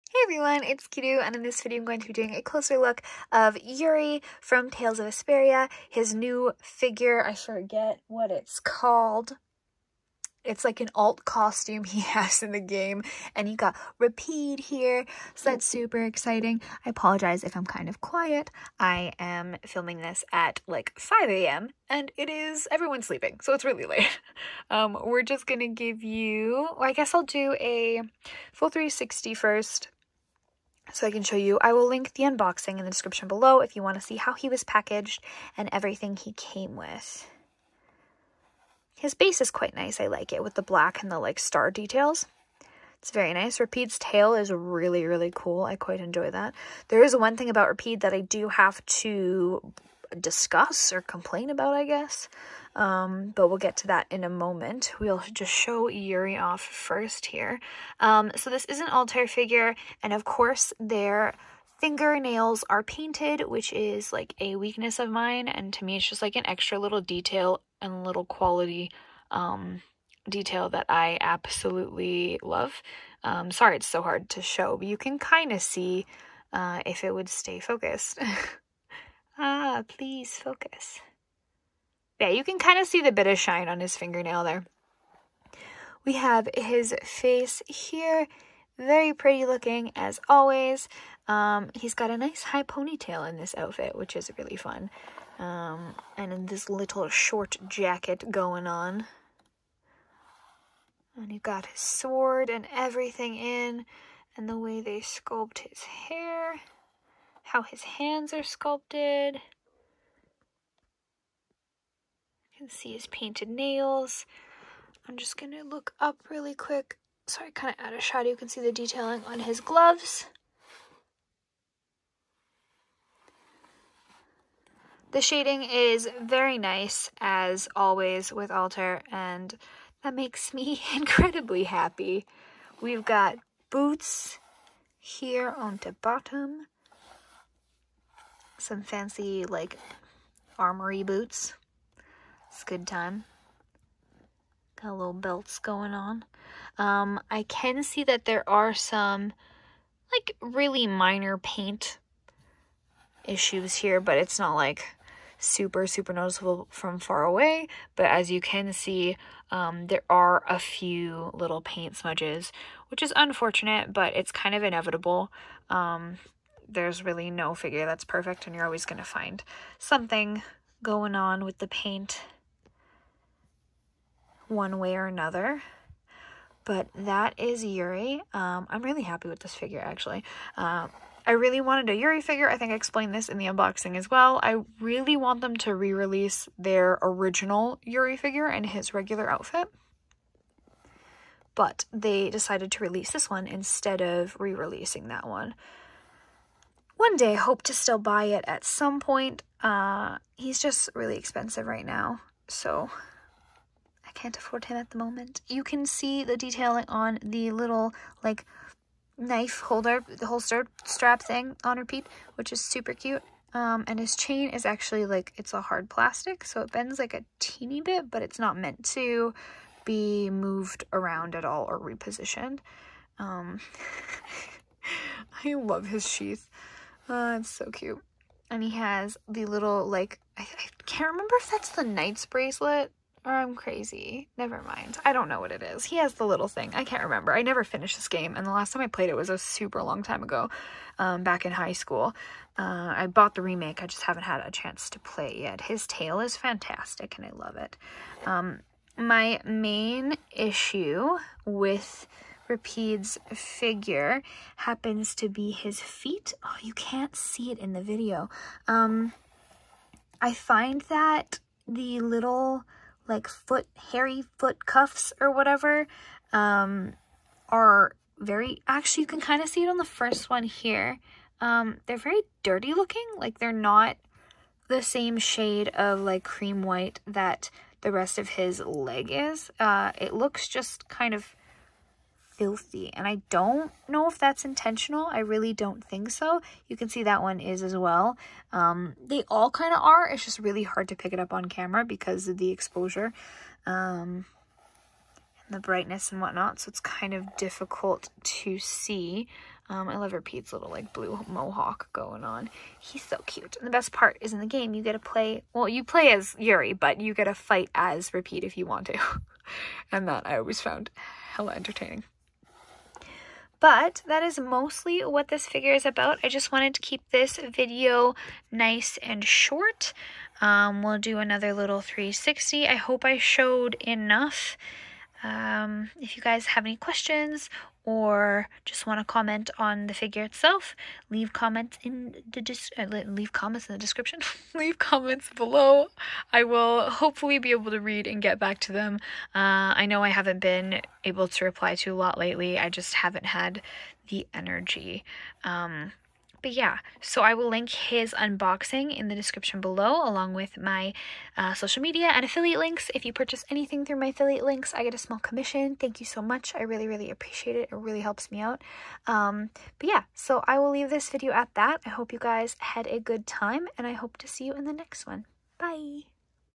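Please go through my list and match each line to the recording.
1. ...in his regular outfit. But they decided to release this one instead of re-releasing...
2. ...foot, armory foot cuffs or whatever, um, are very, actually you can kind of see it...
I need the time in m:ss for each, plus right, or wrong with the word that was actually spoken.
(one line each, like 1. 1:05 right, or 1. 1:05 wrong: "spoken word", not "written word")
1. 3:08 right
2. 4:23 wrong: "hairy", not "armory".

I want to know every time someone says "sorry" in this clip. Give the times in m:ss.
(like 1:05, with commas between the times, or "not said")
1:13, 1:57.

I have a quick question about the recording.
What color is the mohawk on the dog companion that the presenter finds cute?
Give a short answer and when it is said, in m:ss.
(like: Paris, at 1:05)
Blue, at 5:00.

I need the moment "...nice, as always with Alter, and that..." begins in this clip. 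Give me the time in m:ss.
2:06.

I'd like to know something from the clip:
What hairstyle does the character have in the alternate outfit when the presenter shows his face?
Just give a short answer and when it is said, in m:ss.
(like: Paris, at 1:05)
High ponytail, at 1:32.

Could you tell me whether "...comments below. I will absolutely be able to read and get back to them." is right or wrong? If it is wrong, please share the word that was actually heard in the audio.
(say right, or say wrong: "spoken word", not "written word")
wrong: "hopefully", not "absolutely".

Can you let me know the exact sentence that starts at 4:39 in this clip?
Uh, it looks just kind of filthy.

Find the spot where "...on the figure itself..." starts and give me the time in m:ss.
5:29.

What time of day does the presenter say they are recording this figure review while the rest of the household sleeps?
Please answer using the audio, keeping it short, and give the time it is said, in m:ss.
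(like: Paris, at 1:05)
5 a.m., at 0:20.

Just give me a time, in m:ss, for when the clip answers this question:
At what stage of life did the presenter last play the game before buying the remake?
4:01.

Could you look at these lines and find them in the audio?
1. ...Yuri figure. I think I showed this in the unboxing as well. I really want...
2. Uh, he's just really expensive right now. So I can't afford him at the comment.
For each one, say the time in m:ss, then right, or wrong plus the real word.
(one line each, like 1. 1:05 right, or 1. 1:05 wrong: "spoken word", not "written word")
1. 3:01 wrong: "explained", not "showed"
2. 3:19 wrong: "moment", not "comment".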